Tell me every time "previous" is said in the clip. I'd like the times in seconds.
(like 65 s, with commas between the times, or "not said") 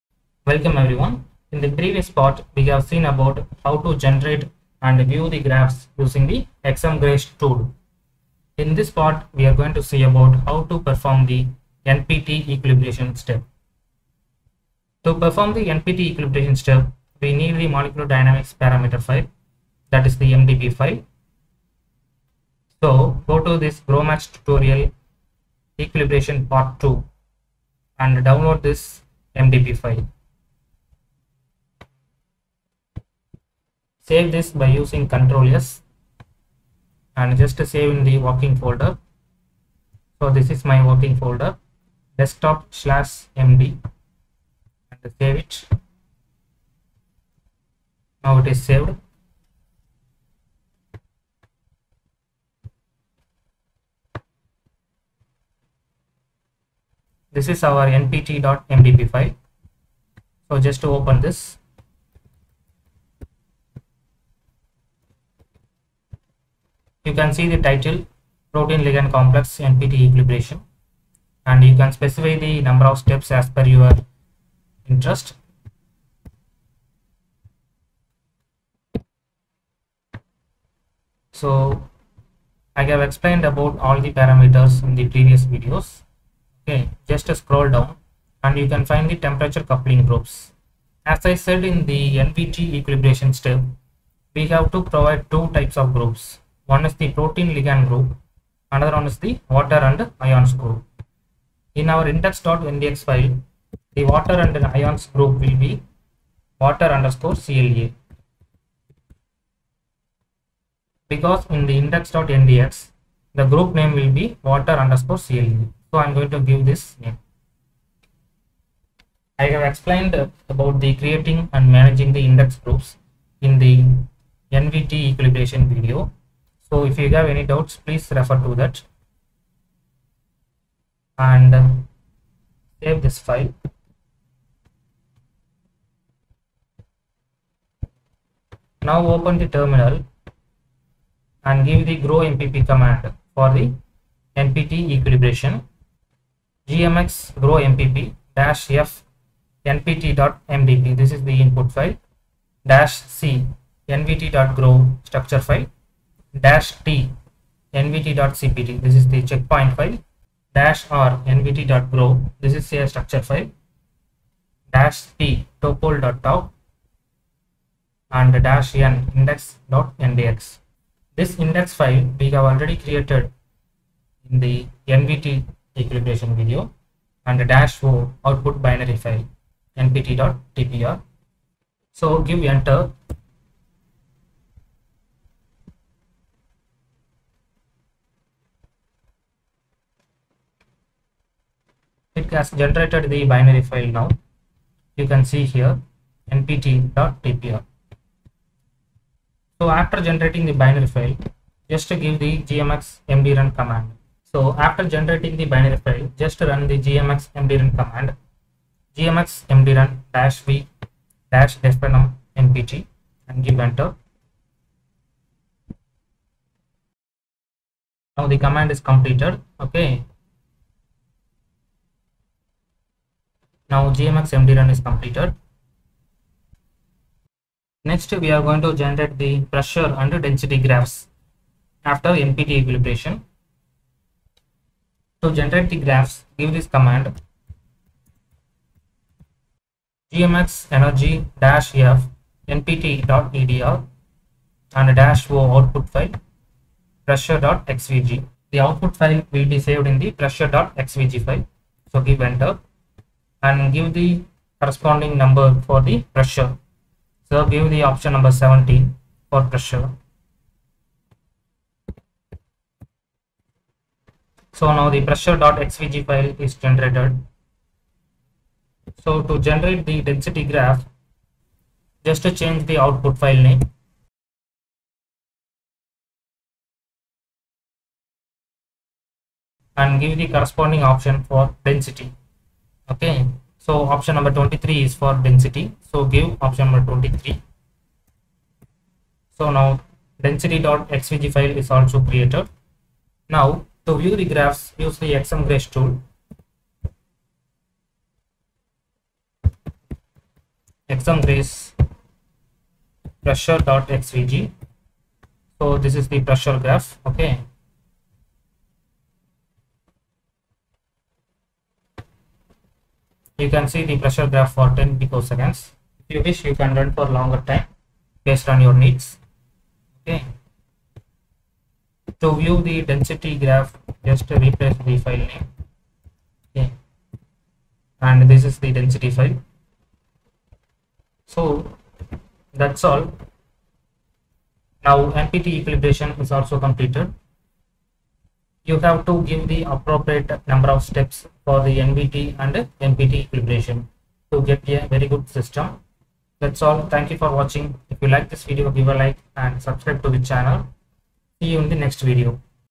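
1 s, 85 s.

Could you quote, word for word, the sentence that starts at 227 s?
Next, we are going to generate the pressure and density graphs after NPT equilibration.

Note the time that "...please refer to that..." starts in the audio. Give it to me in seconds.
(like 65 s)
127 s.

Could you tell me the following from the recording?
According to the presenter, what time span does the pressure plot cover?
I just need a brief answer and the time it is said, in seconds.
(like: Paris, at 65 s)
10 picoseconds, at 314 s.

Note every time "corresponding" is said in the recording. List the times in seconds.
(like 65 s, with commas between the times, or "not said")
254 s, 280 s.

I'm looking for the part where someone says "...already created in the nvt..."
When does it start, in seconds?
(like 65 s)
172 s.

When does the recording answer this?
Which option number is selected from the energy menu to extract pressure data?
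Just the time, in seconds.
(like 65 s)
258 s.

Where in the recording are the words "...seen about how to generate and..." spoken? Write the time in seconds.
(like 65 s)
2 s.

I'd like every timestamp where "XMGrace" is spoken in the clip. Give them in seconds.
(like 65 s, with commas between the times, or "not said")
6 s, 295 s, 300 s.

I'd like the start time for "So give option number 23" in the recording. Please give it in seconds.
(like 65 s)
285 s.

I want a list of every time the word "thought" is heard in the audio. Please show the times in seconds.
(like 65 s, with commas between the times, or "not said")
not said.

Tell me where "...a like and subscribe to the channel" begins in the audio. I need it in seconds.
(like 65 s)
348 s.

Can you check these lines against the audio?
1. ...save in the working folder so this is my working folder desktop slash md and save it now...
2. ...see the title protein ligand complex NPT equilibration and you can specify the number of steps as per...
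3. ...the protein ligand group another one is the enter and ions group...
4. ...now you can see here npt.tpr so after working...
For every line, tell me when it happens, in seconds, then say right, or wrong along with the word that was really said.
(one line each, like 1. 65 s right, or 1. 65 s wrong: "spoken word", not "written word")
1. 37 s right
2. 67 s right
3. 96 s wrong: "water", not "enter"
4. 193 s wrong: "generating", not "working".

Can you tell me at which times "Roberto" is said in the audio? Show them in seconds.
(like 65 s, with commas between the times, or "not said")
not said.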